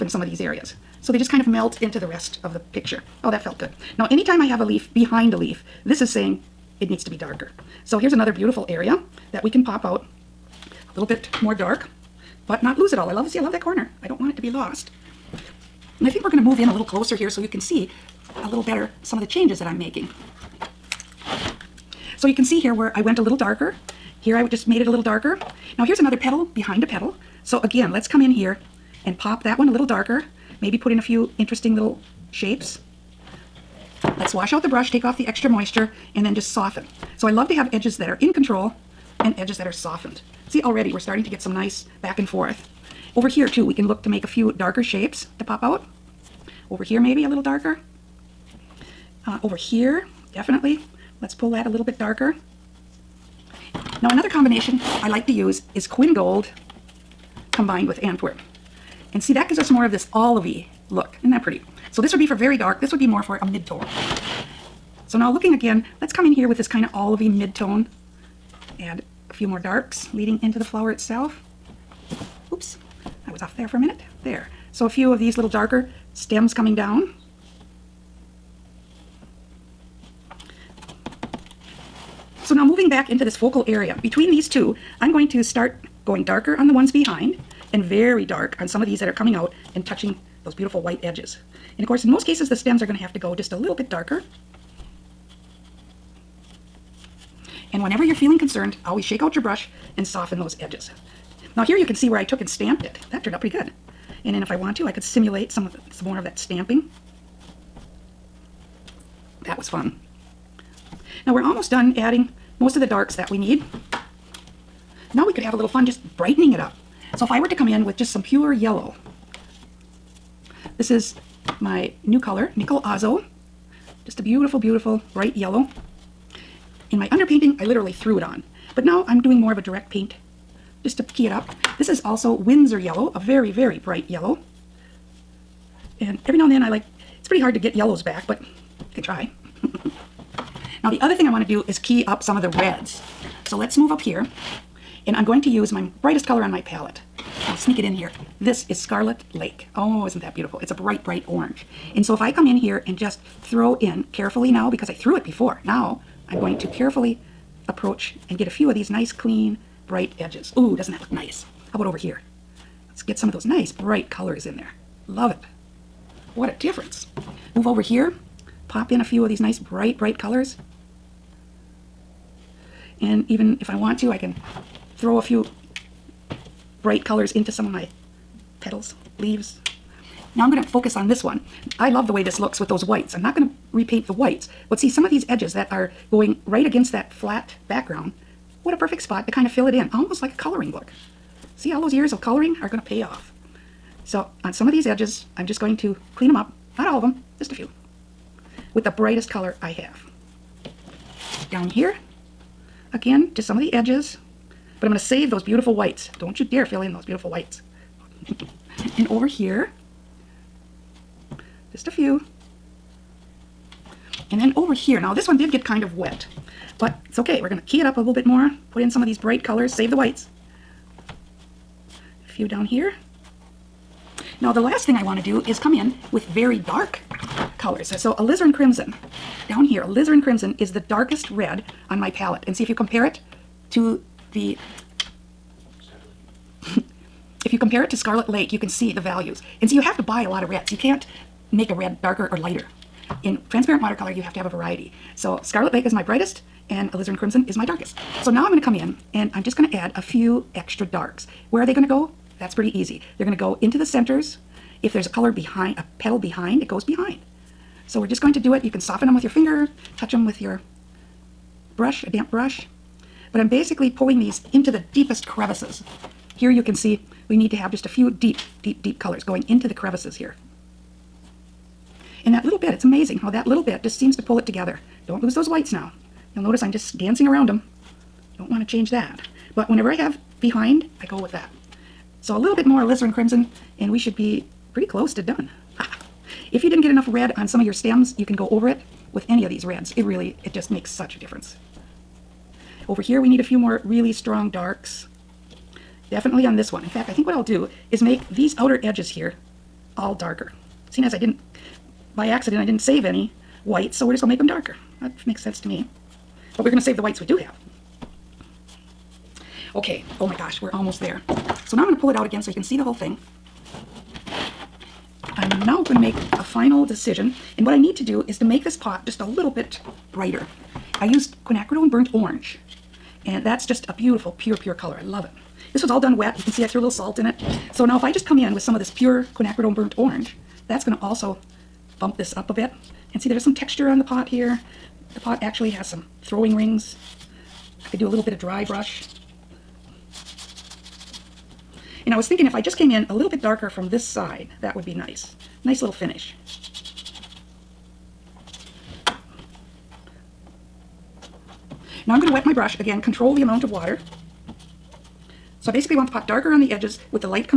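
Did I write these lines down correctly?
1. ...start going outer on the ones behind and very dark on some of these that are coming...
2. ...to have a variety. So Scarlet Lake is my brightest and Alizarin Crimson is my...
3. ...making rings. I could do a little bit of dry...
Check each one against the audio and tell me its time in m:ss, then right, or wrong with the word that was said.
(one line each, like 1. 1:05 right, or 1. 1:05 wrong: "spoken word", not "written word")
1. 1:25 wrong: "darker", not "outer"
2. 4:04 right
3. 5:36 wrong: "throwing", not "making".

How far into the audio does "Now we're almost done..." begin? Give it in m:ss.
1:51.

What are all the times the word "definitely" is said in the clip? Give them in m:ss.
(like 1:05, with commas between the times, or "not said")
0:50, 4:56.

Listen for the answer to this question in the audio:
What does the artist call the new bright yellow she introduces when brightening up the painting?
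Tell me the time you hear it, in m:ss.
2:02.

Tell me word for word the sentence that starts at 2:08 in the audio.
But now I'm doing more of a direct paint just to key it up.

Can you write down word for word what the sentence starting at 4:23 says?
But I'm basically pulling these into the deepest crevices.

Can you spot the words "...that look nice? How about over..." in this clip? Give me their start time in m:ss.
2:40.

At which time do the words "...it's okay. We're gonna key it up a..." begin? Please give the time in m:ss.
3:37.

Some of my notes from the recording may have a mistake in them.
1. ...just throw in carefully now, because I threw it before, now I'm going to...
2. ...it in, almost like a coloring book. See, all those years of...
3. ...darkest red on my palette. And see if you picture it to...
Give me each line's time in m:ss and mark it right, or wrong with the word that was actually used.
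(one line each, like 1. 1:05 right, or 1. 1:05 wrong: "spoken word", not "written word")
1. 2:32 right
2. 3:09 right
3. 3:50 wrong: "compare", not "picture".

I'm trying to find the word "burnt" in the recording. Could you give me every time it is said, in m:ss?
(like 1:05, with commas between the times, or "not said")
5:21, 5:29.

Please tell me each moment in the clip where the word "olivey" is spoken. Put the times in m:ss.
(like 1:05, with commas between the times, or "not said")
1:00, 1:06.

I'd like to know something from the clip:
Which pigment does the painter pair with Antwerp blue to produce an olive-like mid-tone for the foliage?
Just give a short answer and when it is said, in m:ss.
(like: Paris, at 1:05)
Quin Gold, at 0:55.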